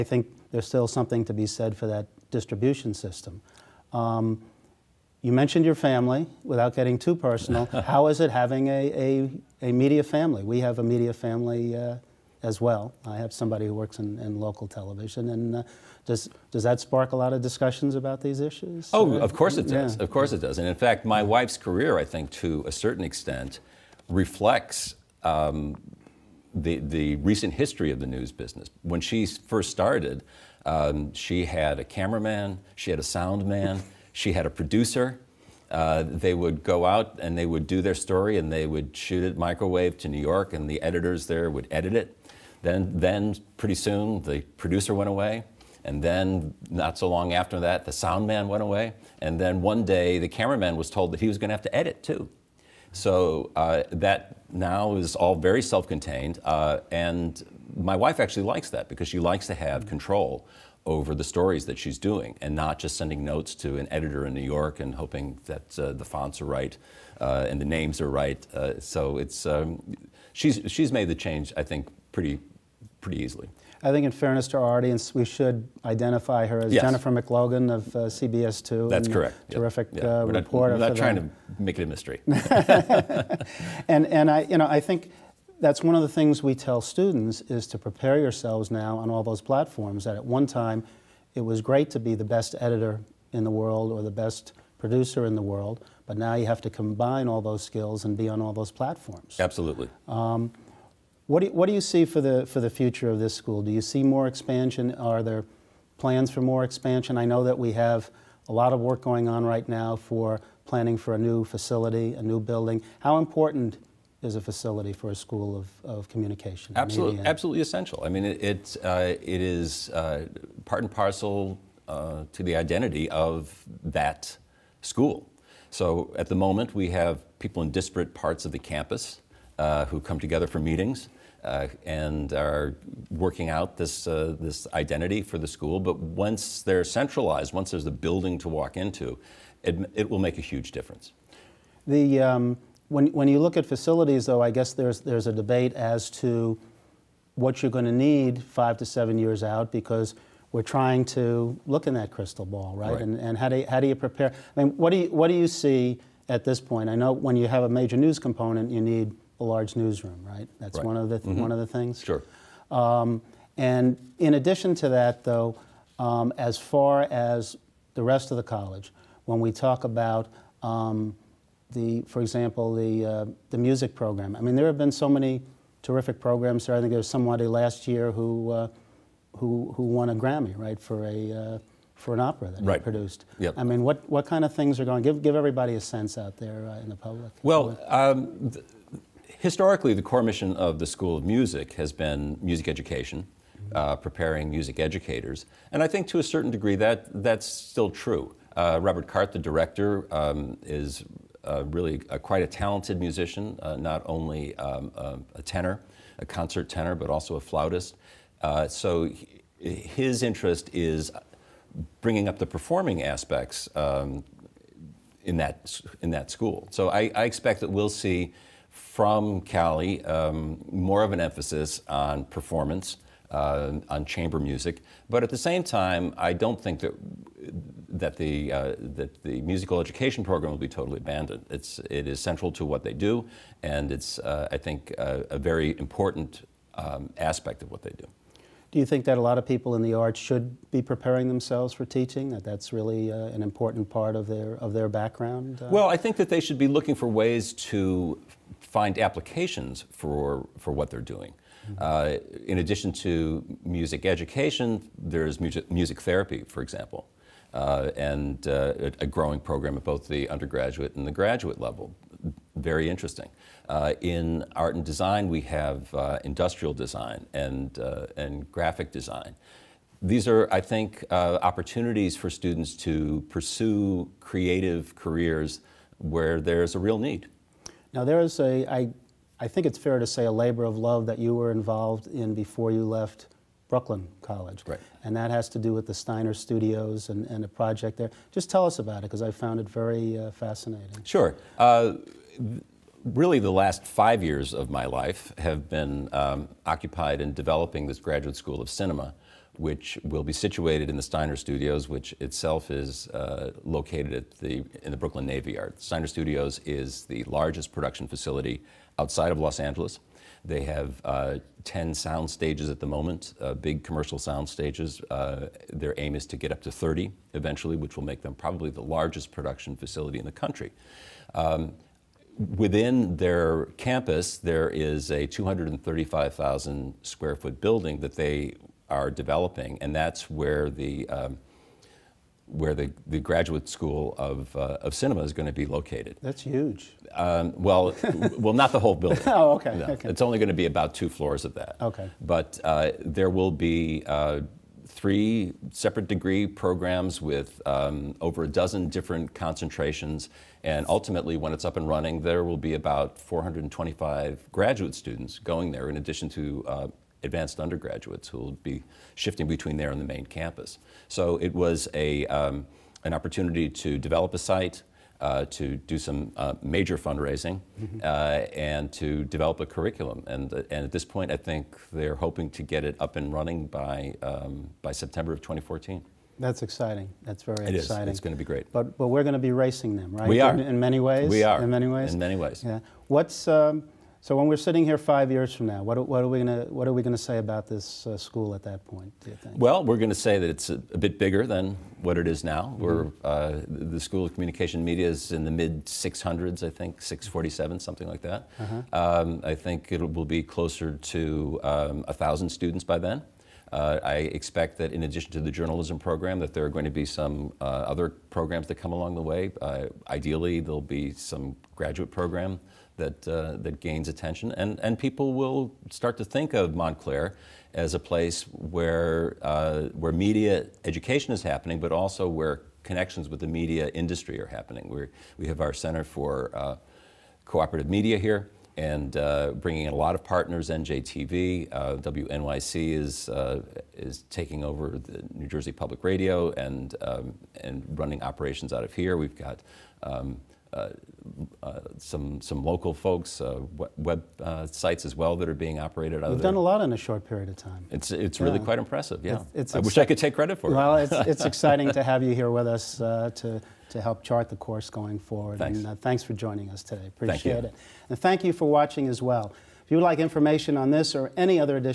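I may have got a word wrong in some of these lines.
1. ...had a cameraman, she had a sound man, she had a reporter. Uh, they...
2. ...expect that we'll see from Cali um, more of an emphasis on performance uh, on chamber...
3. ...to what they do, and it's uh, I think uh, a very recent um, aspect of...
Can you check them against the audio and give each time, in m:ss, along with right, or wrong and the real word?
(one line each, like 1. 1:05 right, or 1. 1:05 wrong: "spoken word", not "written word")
1. 0:31 wrong: "producer", not "reporter"
2. 3:37 right
3. 3:52 wrong: "important", not "recent".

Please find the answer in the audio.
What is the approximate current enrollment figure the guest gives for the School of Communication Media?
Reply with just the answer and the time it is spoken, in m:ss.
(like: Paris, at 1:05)
647, at 6:37.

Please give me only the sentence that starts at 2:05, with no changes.
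So at the moment, we have people in disparate parts of the campus uh, who come together for meetings.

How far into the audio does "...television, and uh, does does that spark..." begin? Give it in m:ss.
0:14.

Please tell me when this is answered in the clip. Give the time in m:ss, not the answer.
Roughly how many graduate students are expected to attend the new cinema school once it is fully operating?
5:53.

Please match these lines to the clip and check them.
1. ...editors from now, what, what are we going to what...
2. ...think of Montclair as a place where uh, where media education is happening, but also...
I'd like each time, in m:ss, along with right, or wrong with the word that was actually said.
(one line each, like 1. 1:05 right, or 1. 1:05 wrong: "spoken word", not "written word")
1. 6:25 wrong: "years", not "editors"
2. 6:56 right.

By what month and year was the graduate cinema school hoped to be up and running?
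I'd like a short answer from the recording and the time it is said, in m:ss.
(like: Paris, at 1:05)
September 2014, at 6:14.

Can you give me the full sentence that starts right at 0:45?
And then, not so long after that, the sound man went away.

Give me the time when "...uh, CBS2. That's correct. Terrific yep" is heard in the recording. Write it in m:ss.
1:17.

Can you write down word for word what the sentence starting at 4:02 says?
That that's really uh, an important part of their of their background.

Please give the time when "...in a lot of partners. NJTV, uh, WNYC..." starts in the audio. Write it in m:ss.
7:09.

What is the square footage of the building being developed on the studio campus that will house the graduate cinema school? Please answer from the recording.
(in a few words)
235,000 square feet.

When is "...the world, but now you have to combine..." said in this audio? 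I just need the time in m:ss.
1:35.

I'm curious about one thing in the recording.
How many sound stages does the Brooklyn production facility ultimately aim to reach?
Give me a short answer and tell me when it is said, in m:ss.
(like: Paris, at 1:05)
30, at 5:16.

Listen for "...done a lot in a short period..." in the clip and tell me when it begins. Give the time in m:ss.
7:26.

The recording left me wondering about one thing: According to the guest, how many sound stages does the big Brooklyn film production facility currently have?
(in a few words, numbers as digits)
10.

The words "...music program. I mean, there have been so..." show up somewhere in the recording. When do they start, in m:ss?
2:53.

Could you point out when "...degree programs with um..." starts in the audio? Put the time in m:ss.
5:46.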